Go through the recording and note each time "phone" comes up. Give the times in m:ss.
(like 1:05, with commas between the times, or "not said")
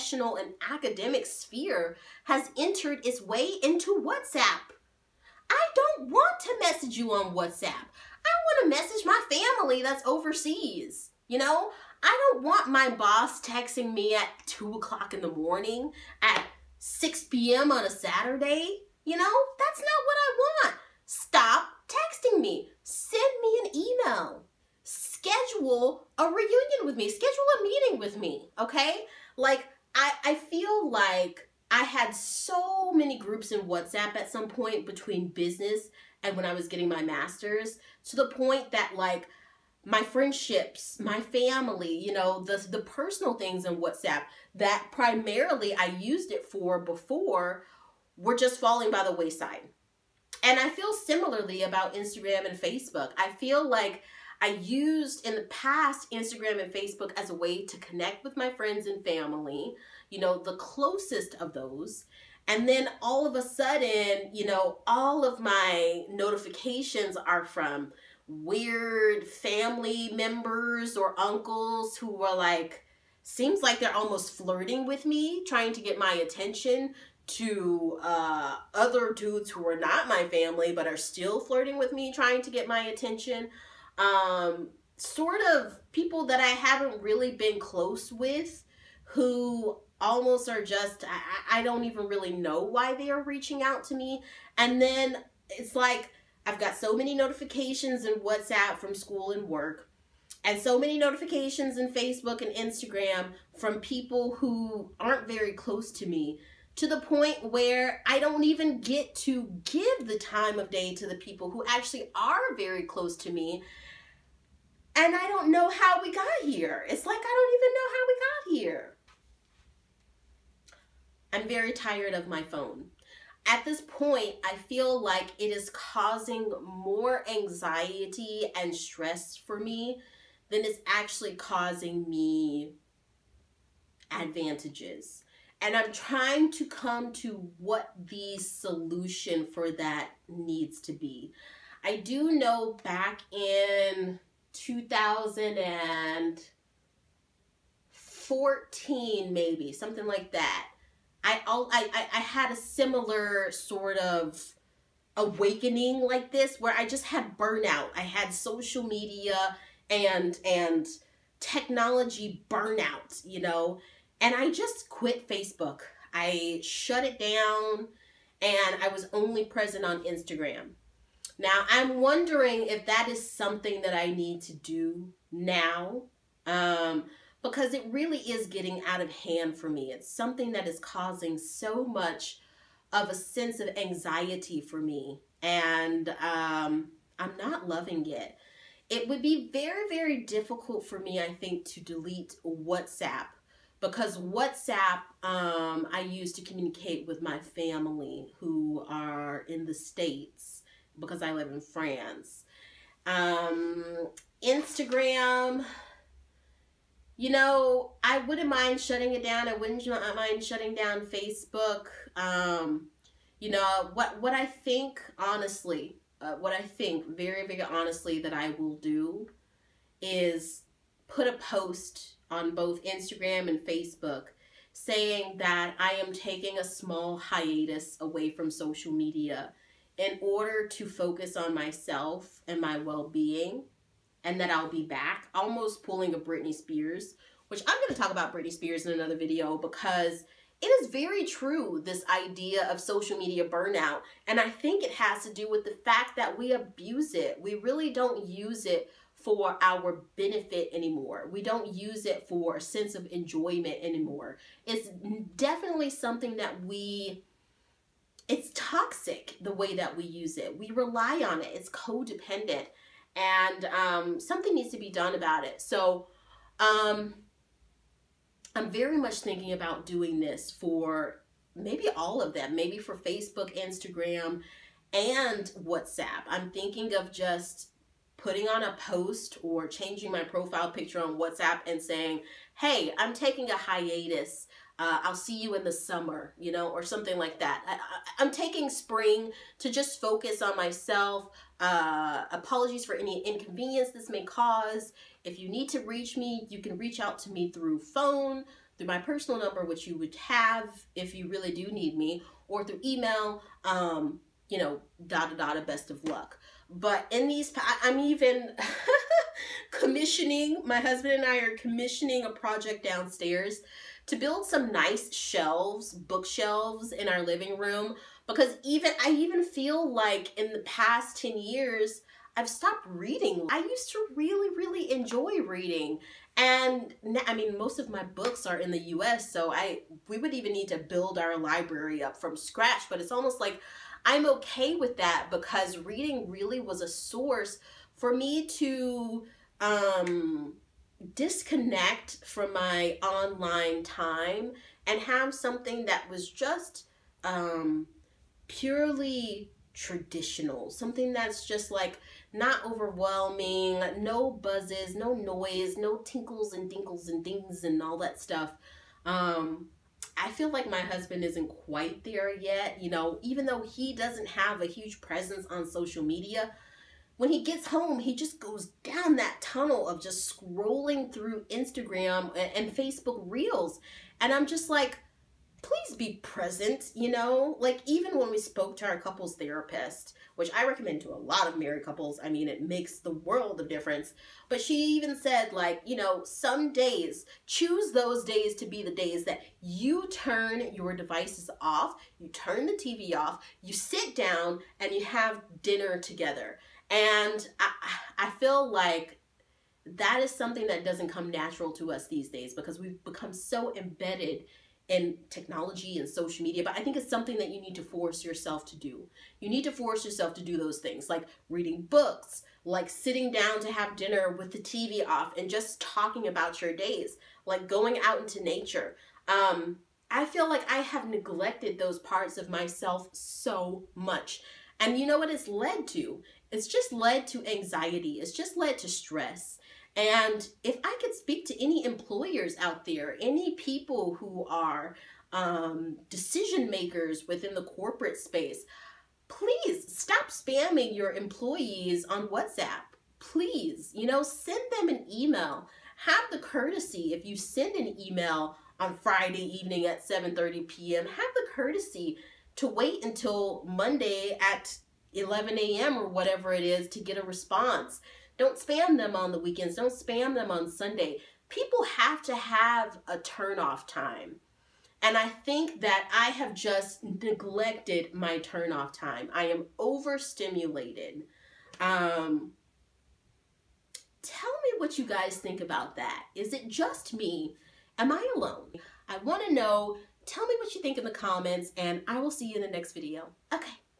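2:02, 4:57.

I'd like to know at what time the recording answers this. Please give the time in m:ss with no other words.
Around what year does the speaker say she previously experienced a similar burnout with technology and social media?
2:24.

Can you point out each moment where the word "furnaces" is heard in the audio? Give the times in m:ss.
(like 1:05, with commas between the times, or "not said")
not said.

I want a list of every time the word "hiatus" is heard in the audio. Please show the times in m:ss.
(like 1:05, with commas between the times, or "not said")
3:47, 4:43.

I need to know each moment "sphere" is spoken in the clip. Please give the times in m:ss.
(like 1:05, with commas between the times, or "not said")
0:01.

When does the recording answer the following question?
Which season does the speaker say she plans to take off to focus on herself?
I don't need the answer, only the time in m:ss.
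4:48.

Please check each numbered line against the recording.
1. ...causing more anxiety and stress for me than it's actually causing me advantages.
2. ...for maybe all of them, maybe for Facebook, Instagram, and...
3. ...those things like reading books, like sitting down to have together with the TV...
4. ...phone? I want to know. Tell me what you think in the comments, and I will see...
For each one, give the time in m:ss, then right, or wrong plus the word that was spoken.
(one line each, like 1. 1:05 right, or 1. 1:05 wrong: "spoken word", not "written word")
1. 2:05 right
2. 4:30 right
3. 6:50 wrong: "dinner", not "together"
4. 7:58 wrong: "alone", not "phone".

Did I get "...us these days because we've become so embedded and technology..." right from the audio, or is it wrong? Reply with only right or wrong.
right.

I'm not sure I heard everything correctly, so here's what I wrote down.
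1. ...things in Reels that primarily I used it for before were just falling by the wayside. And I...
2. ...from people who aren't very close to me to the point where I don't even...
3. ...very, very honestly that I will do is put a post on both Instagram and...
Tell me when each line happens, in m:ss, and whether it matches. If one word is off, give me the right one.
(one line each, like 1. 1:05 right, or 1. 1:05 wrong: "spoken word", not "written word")
1. 0:43 wrong: "WhatsApp", not "Reels"
2. 1:43 right
3. 3:37 right.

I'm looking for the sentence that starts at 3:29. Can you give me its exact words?
I wouldn't uh, mind shutting down Facebook.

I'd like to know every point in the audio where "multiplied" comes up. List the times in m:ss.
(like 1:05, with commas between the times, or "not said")
not said.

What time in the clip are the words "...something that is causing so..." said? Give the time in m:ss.
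3:00.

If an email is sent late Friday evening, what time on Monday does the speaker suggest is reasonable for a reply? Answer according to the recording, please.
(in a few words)
11 a.m.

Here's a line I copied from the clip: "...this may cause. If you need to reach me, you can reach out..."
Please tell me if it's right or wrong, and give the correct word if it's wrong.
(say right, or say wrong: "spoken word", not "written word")
right.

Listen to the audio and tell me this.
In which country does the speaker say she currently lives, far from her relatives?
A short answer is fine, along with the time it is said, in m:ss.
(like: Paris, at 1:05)
France, at 3:21.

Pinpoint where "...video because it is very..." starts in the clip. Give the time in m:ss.
3:59.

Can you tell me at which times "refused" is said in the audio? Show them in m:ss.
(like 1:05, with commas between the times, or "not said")
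not said.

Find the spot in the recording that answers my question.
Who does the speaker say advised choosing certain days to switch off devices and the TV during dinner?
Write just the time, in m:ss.
6:18.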